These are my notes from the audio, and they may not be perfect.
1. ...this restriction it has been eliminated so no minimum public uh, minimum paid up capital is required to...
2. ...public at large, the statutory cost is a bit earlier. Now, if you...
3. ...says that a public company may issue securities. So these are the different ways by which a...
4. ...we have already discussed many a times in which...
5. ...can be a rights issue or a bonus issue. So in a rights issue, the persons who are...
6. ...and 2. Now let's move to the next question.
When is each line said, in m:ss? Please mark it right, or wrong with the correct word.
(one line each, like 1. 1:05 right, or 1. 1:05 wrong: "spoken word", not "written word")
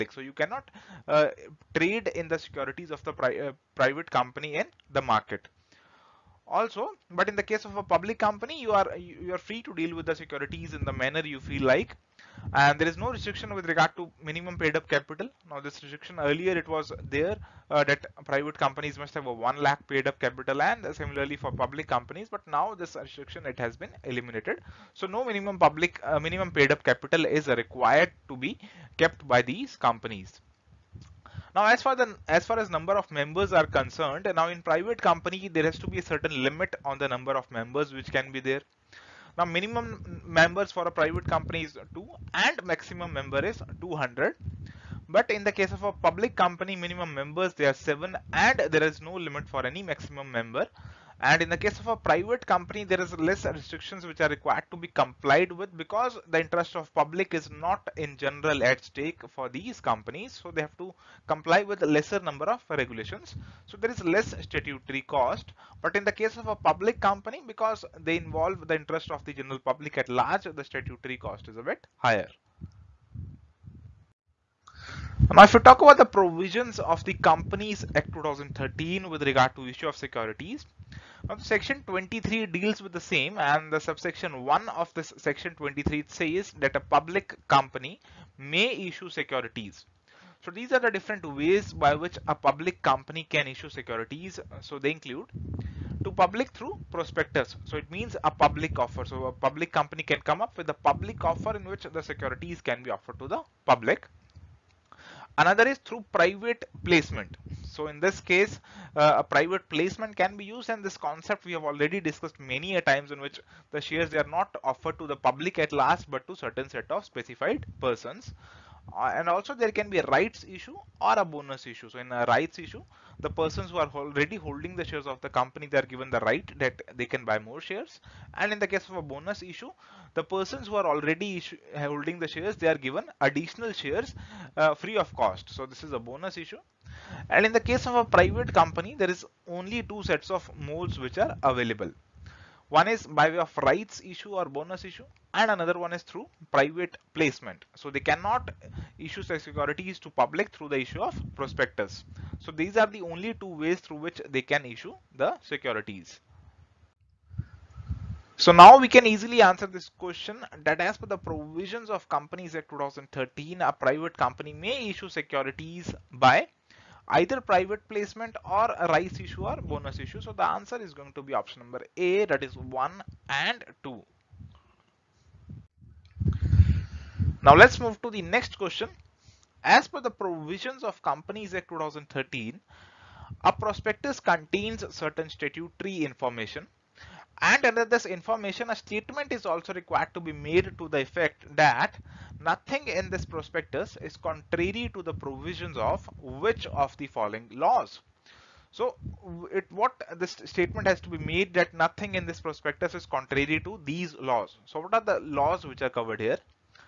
1. 0:22 right
2. 1:09 wrong: "higher", not "earlier"
3. 1:26 right
4. 1:51 right
5. 1:59 right
6. 2:53 right.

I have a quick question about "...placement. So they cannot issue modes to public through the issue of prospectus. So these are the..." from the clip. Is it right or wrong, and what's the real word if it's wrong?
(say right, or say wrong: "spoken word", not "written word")
wrong: "securities", not "modes".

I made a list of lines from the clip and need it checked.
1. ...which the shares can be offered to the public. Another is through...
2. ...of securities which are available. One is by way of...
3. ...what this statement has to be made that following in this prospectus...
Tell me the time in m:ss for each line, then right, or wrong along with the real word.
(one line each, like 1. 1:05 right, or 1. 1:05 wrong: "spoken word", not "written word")
1. 1:41 wrong: "securities", not "shares"
2. 2:20 wrong: "modes", not "securities"
3. 3:19 wrong: "nothing", not "following".